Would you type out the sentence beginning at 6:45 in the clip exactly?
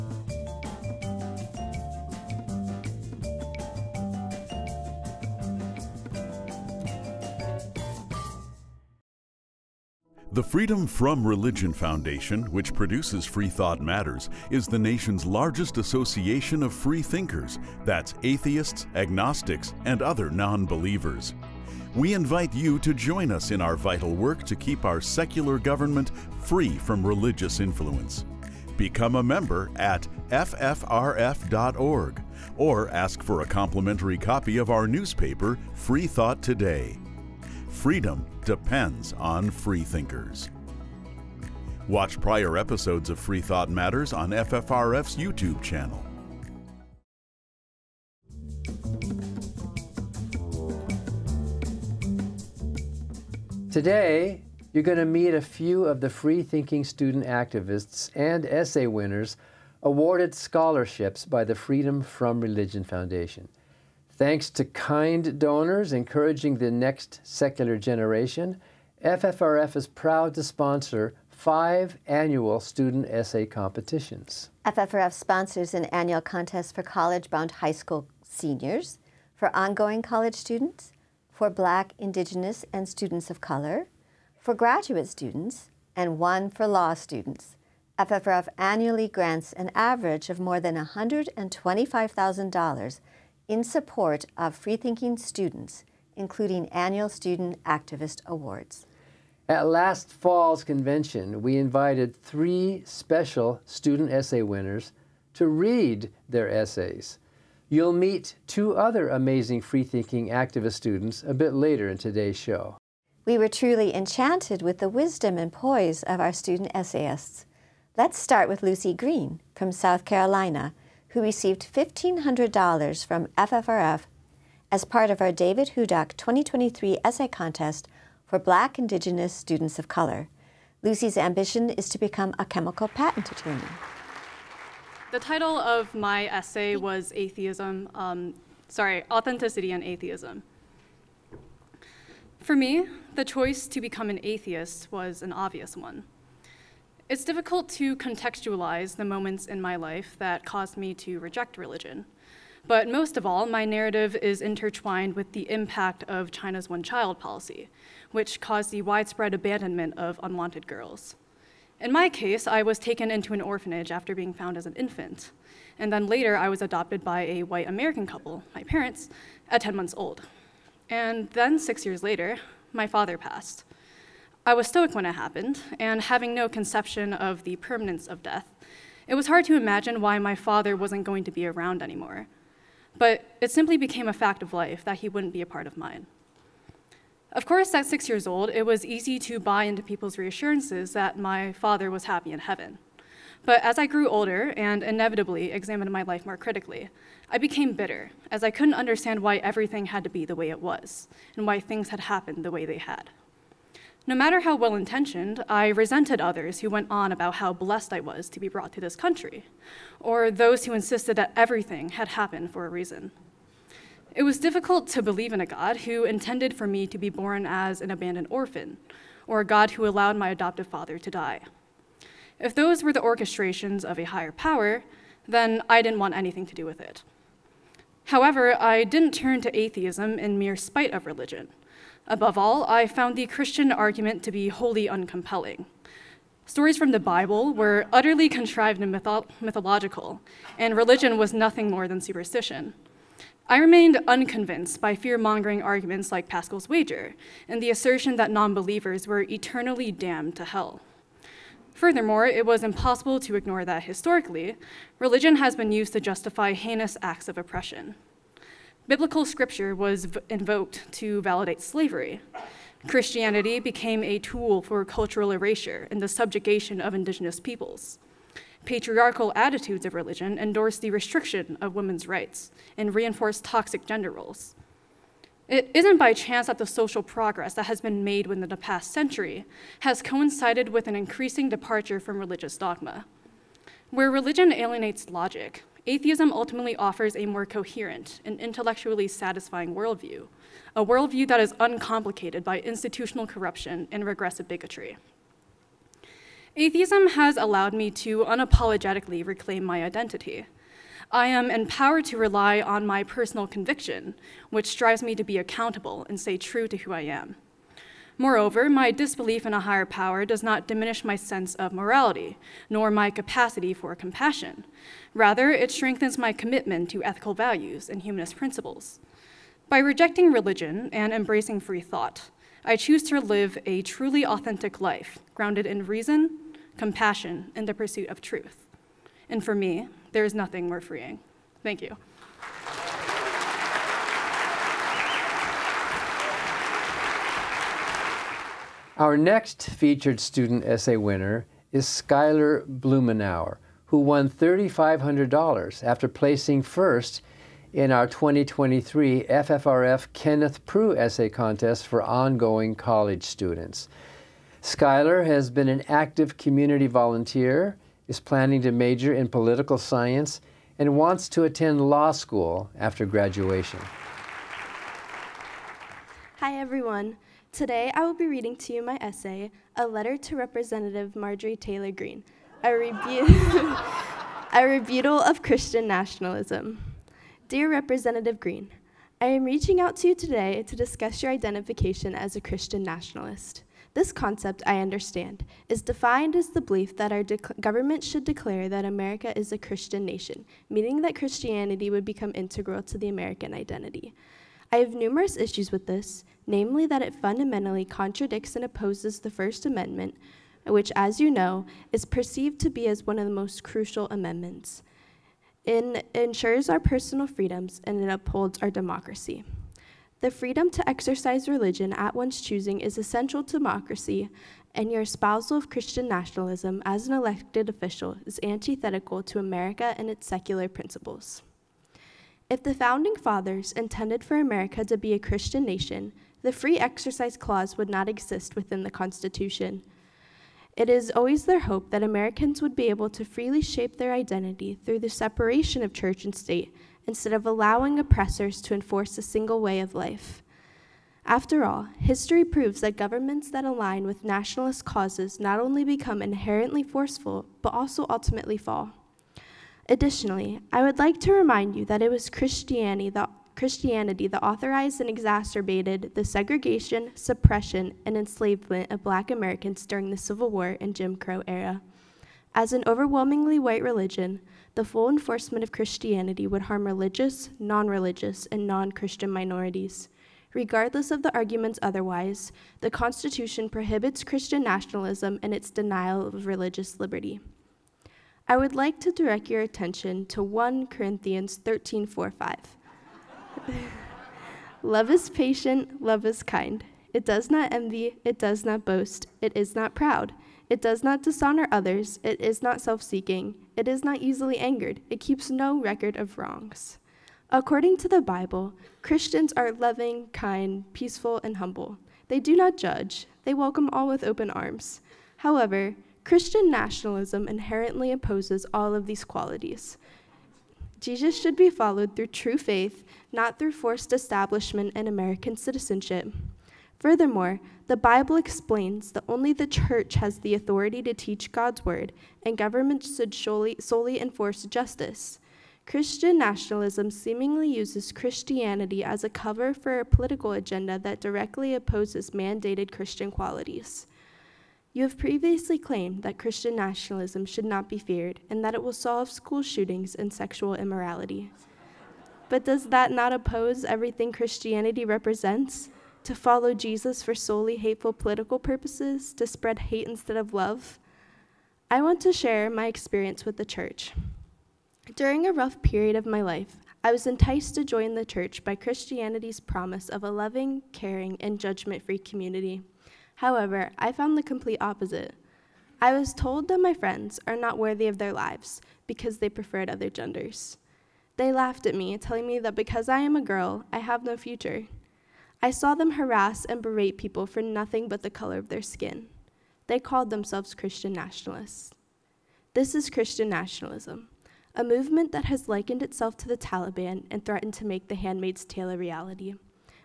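It ensures our personal freedoms and it upholds our democracy.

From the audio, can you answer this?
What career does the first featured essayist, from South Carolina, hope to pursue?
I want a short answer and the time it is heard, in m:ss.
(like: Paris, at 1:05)
chemical patent attorney, at 2:12.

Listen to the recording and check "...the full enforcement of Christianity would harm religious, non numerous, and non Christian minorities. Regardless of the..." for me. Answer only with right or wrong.
wrong.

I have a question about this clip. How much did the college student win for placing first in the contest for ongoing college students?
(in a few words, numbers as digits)
$3,500.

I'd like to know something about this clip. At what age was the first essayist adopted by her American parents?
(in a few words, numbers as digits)
10 months.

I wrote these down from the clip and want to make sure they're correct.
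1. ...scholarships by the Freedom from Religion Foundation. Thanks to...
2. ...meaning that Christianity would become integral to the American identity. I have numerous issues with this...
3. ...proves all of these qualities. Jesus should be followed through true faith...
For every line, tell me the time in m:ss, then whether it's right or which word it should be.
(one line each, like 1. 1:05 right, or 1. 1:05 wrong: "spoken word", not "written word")
1. 1:00 right
2. 6:30 right
3. 8:28 wrong: "opposes", not "proves".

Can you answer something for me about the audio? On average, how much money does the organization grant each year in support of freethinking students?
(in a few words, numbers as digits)
$125,000.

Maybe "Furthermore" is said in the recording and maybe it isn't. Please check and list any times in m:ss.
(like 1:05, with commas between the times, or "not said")
4:11, 8:36.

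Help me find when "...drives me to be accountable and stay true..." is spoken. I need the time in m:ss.
5:04.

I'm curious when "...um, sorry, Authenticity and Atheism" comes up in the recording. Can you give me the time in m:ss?
2:17.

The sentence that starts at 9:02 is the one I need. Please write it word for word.
But does that not oppose everything Christianity represents?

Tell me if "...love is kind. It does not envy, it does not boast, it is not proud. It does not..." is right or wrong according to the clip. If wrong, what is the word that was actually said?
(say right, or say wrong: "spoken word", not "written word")
right.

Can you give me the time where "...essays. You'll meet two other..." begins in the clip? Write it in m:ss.
1:46.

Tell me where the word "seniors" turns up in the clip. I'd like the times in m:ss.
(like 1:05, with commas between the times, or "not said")
1:18.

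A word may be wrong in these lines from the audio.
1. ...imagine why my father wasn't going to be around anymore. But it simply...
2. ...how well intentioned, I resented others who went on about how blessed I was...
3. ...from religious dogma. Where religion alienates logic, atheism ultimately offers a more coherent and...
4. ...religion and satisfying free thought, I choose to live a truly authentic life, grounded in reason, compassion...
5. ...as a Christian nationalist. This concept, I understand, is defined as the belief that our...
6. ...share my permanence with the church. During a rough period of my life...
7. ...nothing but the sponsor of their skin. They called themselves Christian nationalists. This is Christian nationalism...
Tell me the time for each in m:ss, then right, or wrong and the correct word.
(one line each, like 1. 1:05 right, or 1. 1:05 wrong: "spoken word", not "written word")
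1. 2:59 right
2. 3:24 right
3. 4:41 right
4. 5:20 wrong: "embracing", not "satisfying"
5. 6:22 right
6. 9:12 wrong: "experience", not "permanence"
7. 9:37 wrong: "color", not "sponsor".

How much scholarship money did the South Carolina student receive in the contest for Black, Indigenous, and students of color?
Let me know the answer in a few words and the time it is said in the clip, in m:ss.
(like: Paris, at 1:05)
$1,500, at 2:01.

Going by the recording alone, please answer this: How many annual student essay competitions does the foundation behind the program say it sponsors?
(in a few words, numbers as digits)
5.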